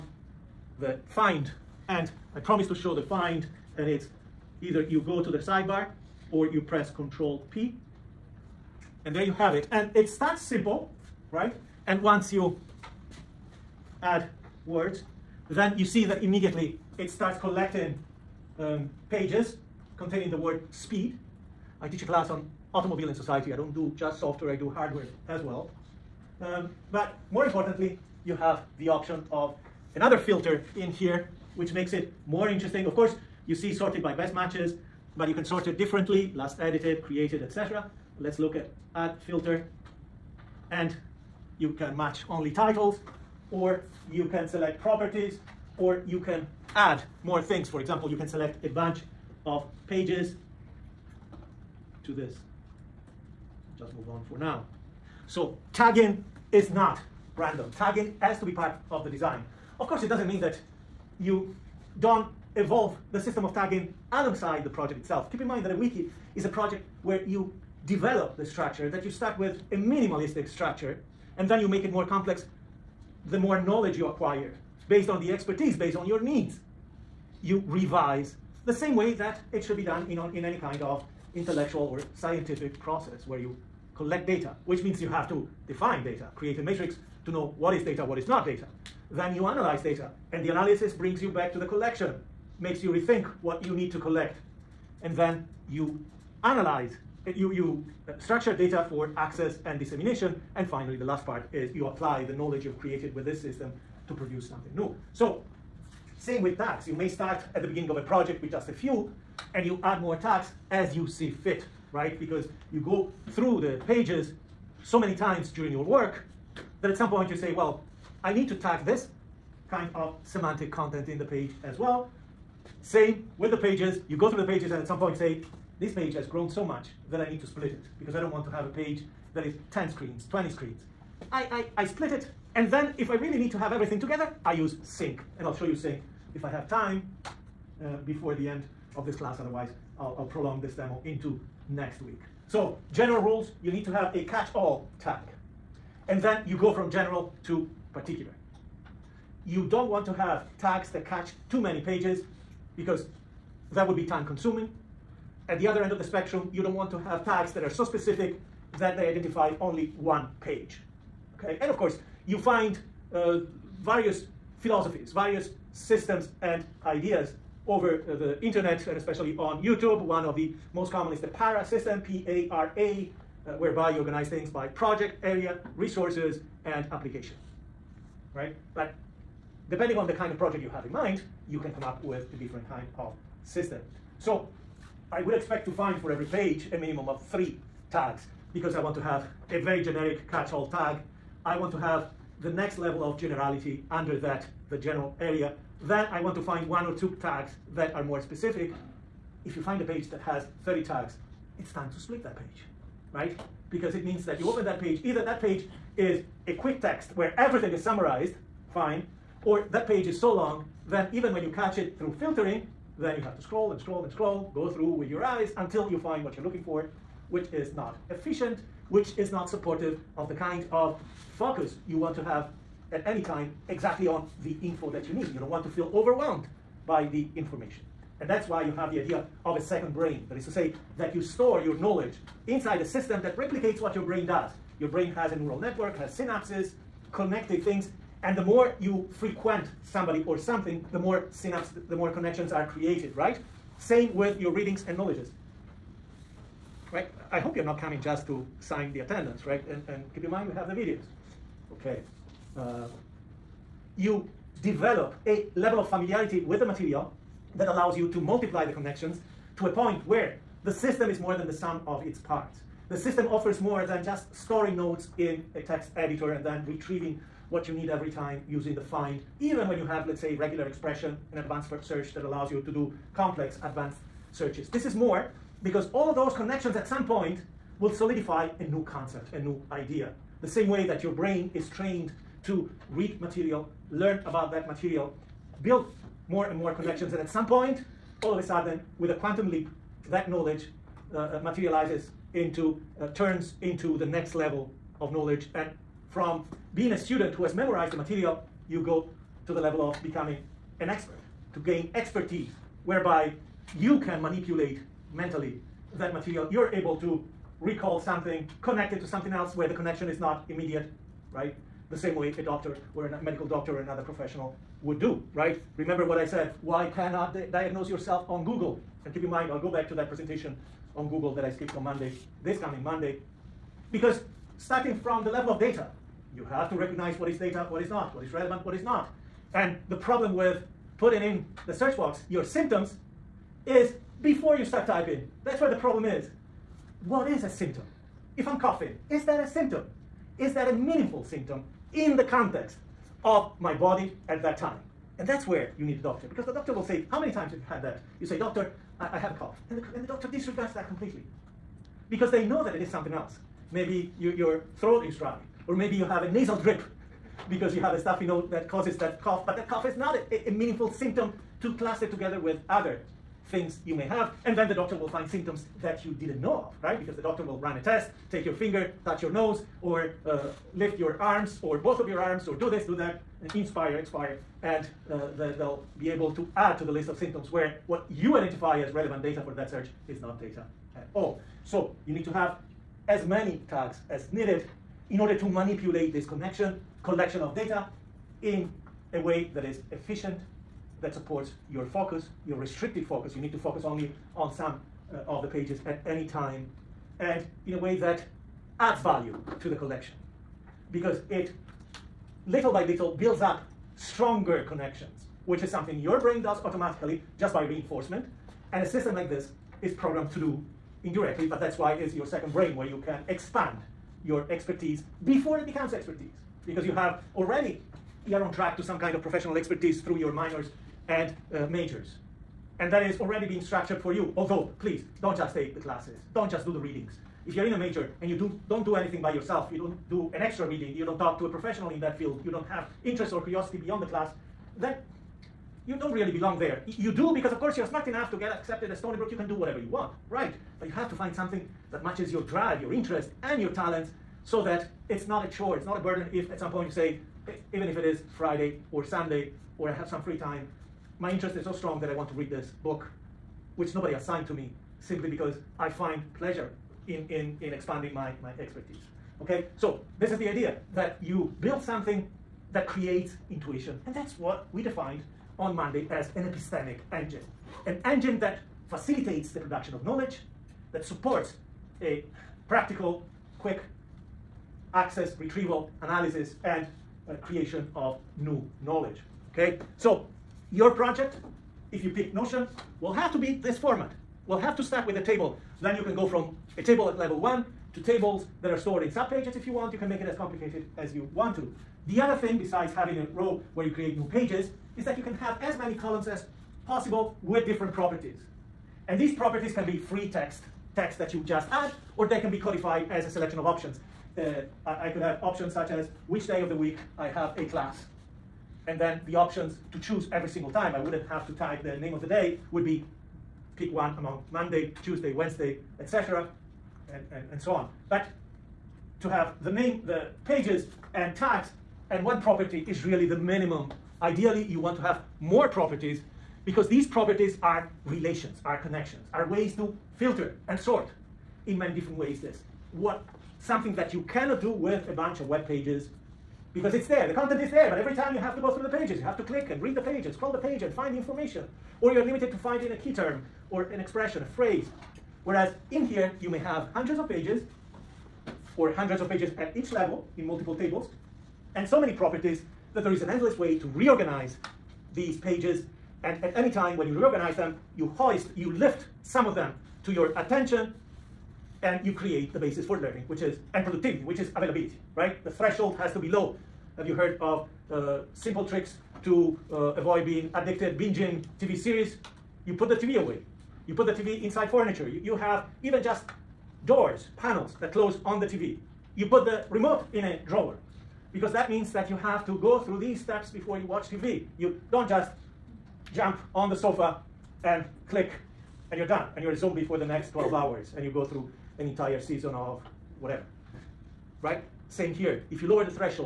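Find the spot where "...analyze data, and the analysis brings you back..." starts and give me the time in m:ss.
1:29.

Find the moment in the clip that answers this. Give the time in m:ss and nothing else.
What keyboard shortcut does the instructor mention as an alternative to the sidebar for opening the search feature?
0:06.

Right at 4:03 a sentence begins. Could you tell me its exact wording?
Same with your readings and knowledges, right?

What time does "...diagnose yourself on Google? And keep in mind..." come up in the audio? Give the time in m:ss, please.
5:17.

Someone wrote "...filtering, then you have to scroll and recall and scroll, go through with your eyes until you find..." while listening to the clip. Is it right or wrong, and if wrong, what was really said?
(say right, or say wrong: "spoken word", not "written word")
wrong: "scroll", not "recall".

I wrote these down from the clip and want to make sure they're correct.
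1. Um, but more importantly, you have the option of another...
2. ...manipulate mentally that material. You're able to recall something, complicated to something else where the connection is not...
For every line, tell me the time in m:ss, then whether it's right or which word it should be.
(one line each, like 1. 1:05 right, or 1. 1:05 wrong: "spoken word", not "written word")
1. 0:26 right
2. 5:04 wrong: "connected", not "complicated".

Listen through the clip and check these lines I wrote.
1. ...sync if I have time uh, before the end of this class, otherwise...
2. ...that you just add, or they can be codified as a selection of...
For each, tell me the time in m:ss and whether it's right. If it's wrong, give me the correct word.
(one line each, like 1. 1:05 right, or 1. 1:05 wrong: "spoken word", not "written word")
1. 2:15 right
2. 8:21 right.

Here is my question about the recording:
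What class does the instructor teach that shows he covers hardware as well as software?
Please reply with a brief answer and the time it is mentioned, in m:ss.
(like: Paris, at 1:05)
automobile in society, at 0:22.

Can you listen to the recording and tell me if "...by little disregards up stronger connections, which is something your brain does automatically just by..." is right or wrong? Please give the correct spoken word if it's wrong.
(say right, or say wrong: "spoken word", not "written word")
wrong: "builds", not "disregards".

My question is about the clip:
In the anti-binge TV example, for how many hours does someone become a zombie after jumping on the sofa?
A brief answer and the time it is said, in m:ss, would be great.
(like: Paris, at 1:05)
12, at 9:50.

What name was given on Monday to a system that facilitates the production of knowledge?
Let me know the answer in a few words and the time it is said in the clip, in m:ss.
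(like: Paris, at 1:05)
epistemic engine, at 7:46.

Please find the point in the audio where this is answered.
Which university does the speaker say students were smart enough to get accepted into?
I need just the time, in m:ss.
7:18.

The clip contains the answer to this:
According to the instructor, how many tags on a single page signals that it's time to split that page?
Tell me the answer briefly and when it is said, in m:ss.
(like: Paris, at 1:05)
30, at 3:20.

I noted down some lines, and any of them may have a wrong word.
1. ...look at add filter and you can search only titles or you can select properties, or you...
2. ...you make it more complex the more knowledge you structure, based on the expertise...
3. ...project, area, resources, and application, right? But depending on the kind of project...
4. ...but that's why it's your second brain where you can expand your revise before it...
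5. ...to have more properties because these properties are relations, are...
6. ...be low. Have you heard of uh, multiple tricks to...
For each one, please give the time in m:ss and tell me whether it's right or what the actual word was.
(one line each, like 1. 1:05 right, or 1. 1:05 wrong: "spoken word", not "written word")
1. 0:38 wrong: "match", not "search"
2. 1:11 wrong: "acquire", not "structure"
3. 2:54 right
4. 6:51 wrong: "expertise", not "revise"
5. 8:44 right
6. 9:26 wrong: "simple", not "multiple".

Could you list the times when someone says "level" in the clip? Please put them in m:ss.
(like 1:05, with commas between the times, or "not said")
3:12, 4:15, 4:54, 4:59, 5:25, 8:07, 9:09.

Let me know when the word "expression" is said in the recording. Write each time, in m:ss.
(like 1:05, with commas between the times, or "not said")
4:30, 9:03.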